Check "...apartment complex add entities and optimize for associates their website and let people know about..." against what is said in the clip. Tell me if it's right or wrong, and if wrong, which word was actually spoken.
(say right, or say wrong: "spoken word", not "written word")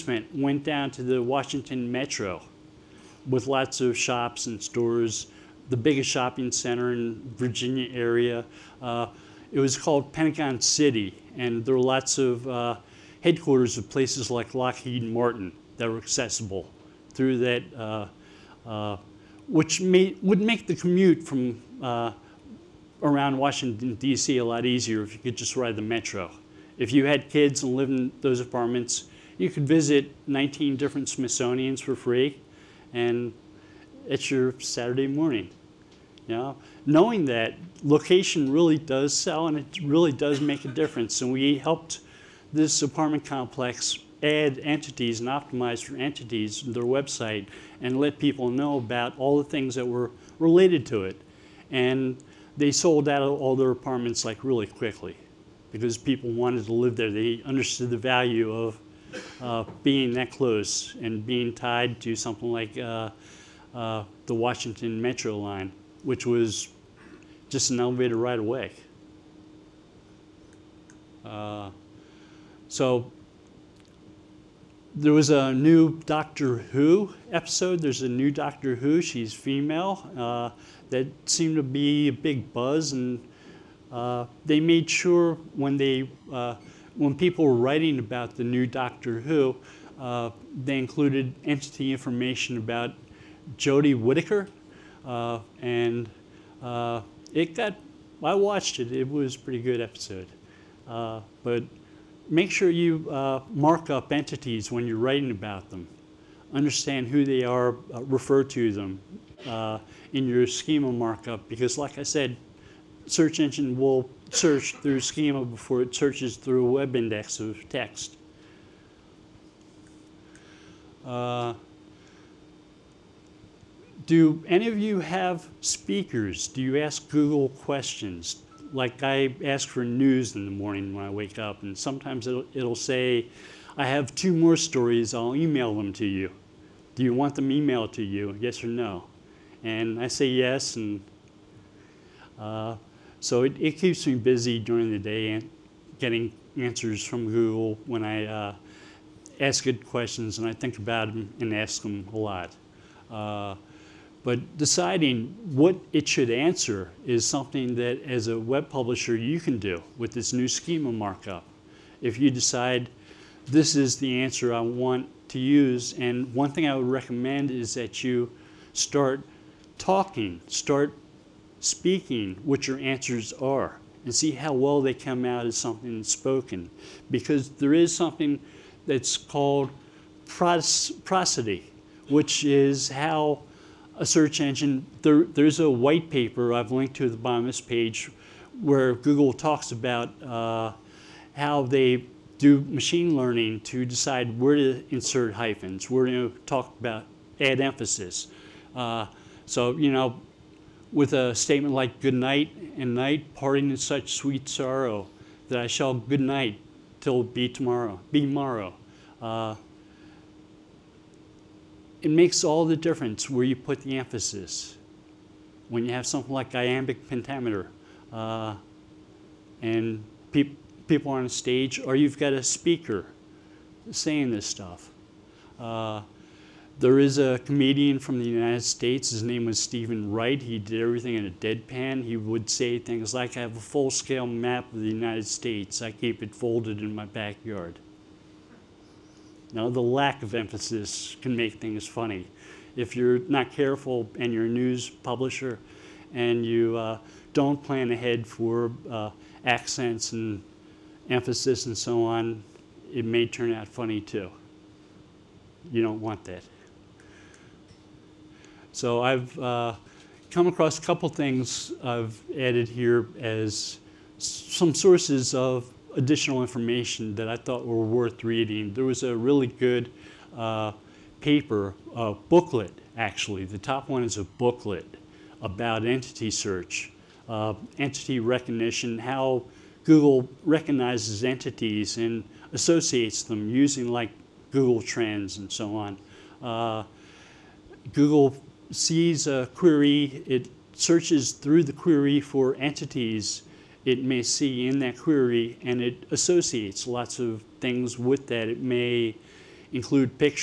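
wrong: "entities", not "associates".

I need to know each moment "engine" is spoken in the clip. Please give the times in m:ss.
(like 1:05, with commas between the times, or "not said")
1:53, 3:04.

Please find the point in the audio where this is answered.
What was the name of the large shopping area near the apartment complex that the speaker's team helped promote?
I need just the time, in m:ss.
0:10.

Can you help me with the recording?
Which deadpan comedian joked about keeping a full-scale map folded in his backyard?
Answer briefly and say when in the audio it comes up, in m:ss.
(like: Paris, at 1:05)
Stephen Wright, at 3:49.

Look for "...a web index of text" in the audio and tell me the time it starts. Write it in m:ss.
1:56.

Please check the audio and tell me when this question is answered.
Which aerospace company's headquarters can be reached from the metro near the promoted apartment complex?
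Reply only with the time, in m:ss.
0:14.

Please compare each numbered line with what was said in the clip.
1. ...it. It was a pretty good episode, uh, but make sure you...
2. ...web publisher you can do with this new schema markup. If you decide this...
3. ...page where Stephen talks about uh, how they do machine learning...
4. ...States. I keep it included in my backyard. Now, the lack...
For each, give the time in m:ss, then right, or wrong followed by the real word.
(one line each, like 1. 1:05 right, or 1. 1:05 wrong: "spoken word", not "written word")
1. 1:38 right
2. 2:38 right
3. 3:07 wrong: "Google", not "Stephen"
4. 3:55 wrong: "folded", not "included".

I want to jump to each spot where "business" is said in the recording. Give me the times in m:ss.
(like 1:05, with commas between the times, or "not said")
not said.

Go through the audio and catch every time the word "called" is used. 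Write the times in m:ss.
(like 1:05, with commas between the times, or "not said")
0:09, 2:59.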